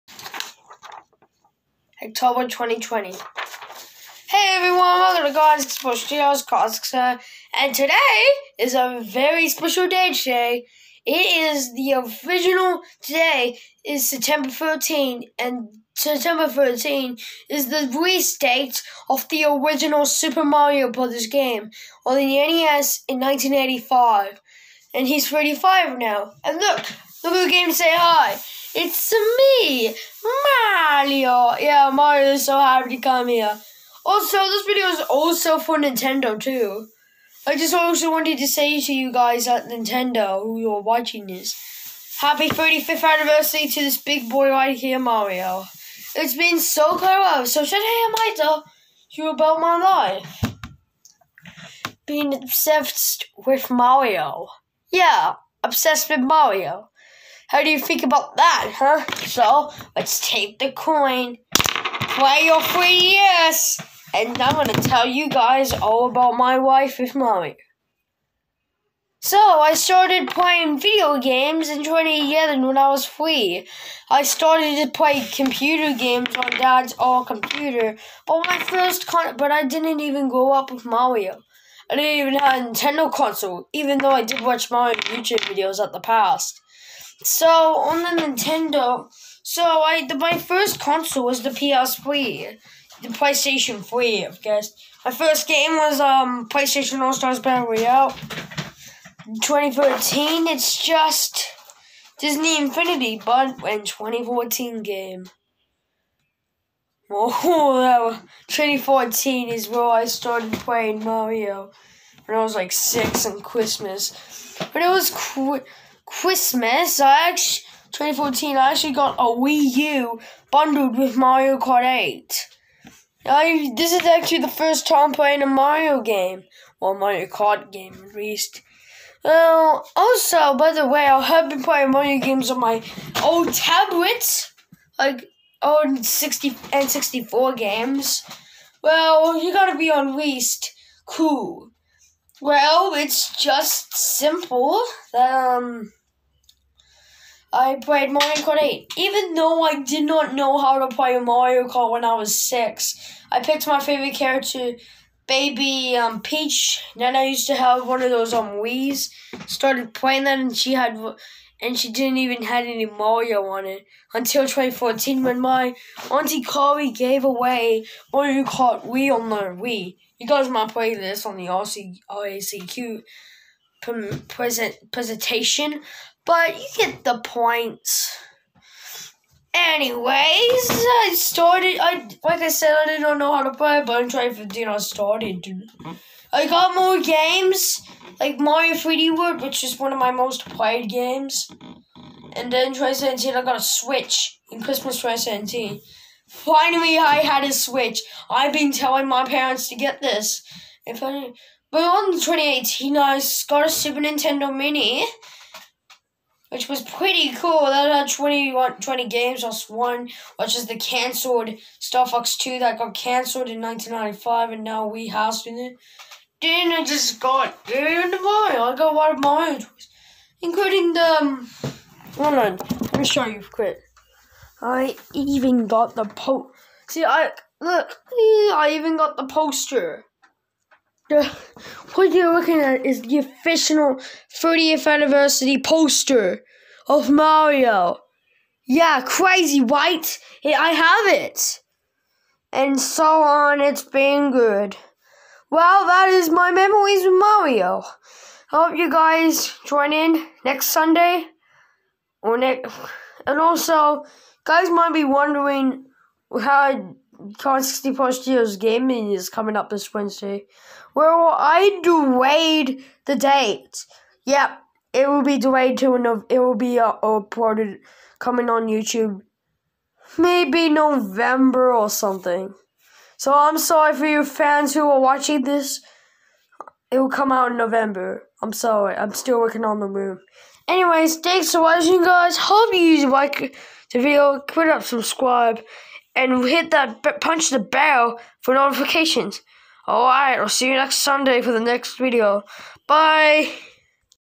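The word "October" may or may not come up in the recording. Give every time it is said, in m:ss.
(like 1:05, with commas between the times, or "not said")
0:02.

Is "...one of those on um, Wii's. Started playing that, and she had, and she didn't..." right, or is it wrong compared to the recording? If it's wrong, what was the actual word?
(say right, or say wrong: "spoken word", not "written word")
right.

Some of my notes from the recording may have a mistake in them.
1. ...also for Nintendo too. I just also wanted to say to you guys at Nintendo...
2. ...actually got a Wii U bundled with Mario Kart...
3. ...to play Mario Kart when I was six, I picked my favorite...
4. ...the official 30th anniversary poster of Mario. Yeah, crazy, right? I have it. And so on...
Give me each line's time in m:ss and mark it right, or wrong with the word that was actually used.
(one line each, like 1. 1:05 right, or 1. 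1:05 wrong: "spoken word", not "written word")
1. 0:35 right
2. 1:58 right
3. 2:30 right
4. 3:53 right.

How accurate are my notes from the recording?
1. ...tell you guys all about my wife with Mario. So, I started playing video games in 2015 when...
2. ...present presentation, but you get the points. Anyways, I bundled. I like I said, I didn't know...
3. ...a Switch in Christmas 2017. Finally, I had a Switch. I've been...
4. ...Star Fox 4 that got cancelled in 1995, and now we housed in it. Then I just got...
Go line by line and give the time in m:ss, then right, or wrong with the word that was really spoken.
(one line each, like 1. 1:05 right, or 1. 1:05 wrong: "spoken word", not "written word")
1. 1:04 wrong: "2011", not "2015"
2. 2:54 wrong: "started", not "bundled"
3. 3:13 right
4. 3:31 wrong: "2", not "4".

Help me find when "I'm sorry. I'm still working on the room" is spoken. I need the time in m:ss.
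4:38.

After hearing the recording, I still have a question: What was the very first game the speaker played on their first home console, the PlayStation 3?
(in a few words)
PlayStation All Stars Battle Royale.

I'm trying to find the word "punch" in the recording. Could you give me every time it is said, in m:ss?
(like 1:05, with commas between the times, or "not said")
4:47.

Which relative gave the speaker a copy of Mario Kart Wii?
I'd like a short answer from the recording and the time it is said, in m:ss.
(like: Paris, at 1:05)
Auntie Carrie, at 2:46.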